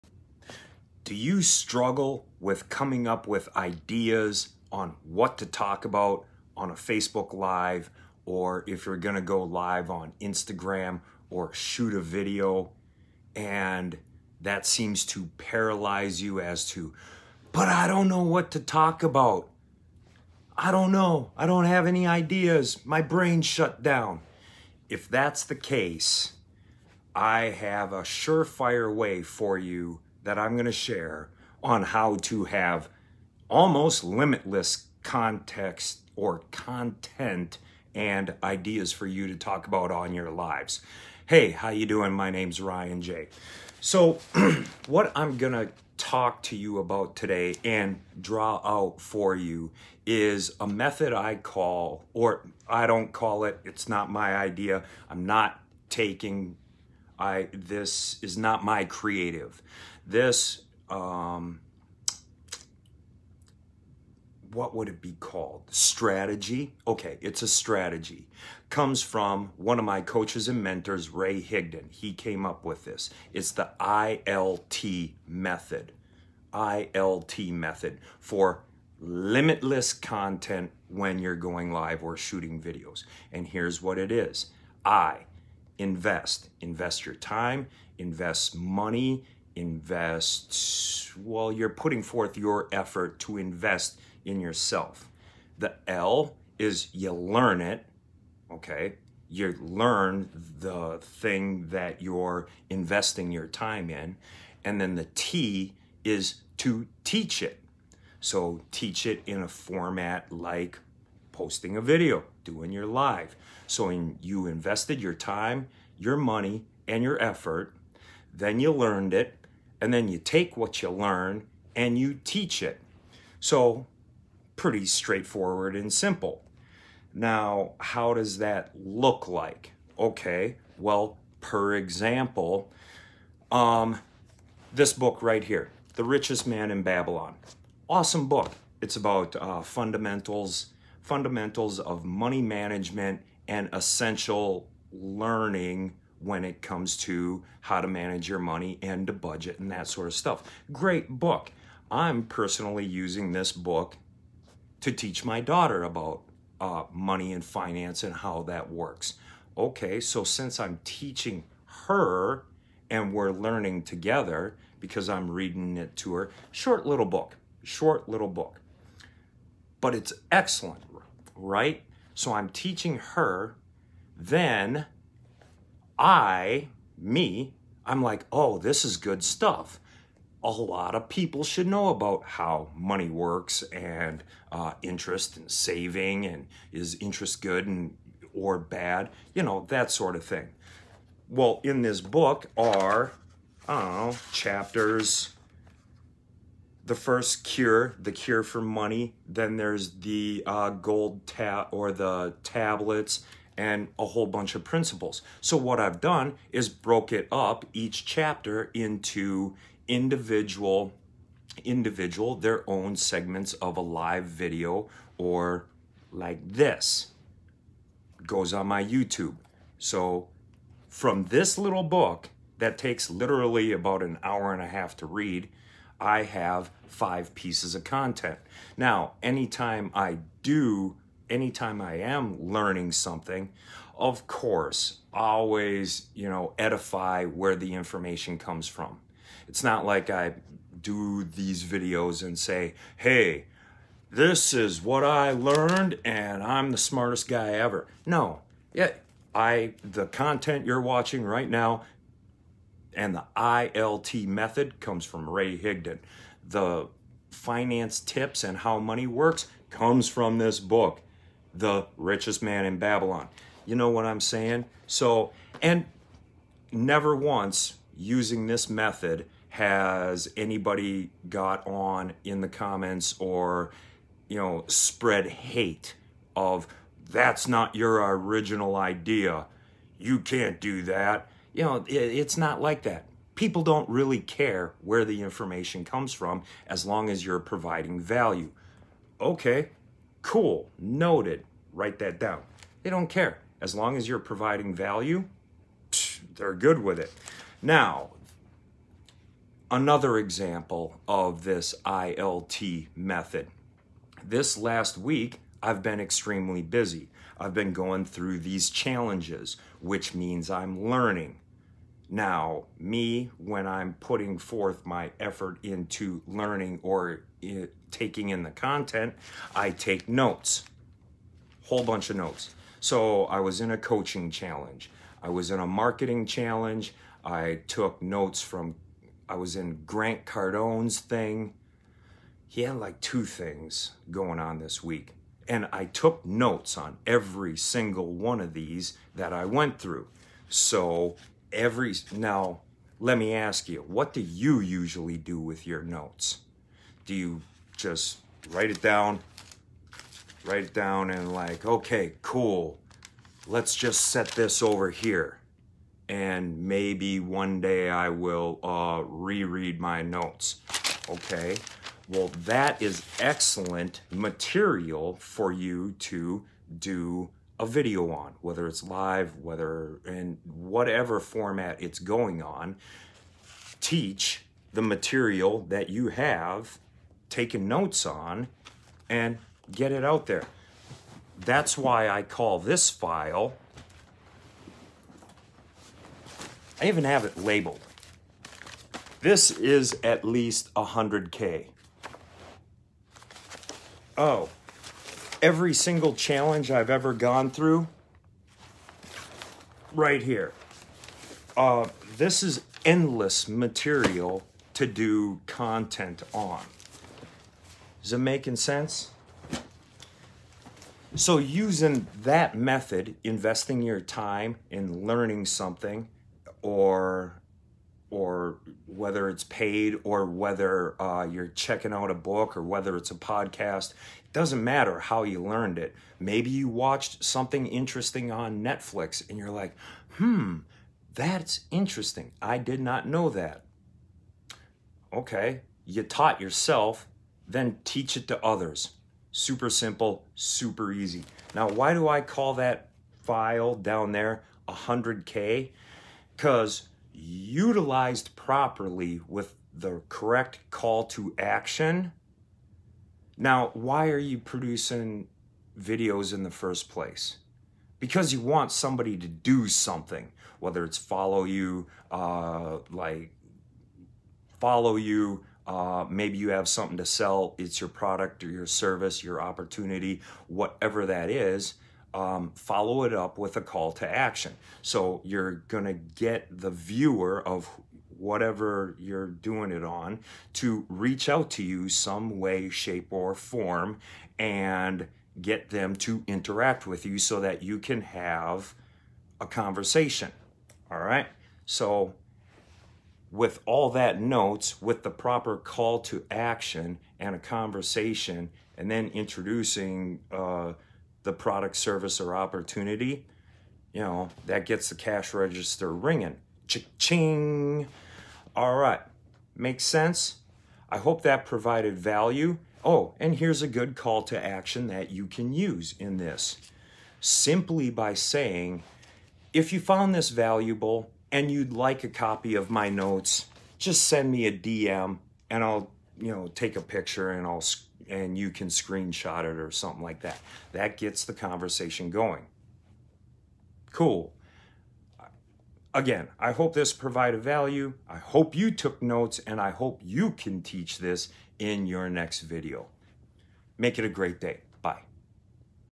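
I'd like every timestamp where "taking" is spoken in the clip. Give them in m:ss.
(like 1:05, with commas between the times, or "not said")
0:55, 5:17, 6:17.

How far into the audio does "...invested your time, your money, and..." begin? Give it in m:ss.
1:54.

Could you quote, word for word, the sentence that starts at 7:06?
Maybe you watched something interesting on Netflix and you're like, hmm, that's interesting.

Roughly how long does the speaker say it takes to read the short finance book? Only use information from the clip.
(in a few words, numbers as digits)
An hour and a half.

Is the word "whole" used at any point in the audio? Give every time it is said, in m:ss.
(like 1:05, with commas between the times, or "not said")
3:24, 5:21.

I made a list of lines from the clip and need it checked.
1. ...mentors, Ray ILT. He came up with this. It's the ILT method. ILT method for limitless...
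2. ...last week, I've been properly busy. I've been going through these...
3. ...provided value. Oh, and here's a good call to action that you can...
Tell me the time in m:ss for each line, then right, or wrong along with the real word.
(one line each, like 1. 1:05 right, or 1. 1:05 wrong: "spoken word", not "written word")
1. 1:10 wrong: "Higdon", not "ILT"
2. 5:04 wrong: "extremely", not "properly"
3. 8:31 right.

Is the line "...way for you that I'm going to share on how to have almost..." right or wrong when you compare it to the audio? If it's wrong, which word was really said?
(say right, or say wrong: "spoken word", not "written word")
right.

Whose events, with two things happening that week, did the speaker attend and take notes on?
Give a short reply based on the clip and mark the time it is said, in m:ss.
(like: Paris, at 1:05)
Grant Cardone, at 5:29.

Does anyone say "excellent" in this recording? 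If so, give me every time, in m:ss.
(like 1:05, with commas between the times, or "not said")
2:50, 6:03.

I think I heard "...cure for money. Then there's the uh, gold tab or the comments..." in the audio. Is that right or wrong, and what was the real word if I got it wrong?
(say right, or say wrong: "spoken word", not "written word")
wrong: "tablets", not "comments".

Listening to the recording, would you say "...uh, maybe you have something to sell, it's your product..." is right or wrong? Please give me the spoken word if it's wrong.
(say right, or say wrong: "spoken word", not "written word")
right.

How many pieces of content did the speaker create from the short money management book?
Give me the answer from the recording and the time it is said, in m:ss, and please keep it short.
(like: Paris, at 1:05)
5, at 3:46.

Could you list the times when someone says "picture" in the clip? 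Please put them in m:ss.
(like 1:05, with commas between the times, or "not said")
8:46.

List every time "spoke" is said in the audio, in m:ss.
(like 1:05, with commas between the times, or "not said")
not said.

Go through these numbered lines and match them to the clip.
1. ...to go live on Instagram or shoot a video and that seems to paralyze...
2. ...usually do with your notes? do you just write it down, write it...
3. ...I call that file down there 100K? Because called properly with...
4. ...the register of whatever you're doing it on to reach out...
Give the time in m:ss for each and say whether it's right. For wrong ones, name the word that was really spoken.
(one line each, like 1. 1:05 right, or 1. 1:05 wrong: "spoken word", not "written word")
1. 0:09 right
2. 5:44 right
3. 7:22 wrong: "utilized", not "called"
4. 7:56 wrong: "viewer", not "register".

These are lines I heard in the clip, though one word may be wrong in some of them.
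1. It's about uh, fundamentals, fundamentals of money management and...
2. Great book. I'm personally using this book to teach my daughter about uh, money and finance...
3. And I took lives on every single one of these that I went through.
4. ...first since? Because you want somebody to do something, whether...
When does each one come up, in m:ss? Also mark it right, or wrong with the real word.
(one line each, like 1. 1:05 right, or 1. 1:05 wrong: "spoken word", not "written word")
1. 2:18 right
2. 2:30 right
3. 5:35 wrong: "notes", not "lives"
4. 7:36 wrong: "place", not "since".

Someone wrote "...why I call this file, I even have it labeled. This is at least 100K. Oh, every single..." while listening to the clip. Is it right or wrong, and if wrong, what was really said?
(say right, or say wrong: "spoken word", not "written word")
right.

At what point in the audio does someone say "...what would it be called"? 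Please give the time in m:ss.
1:04.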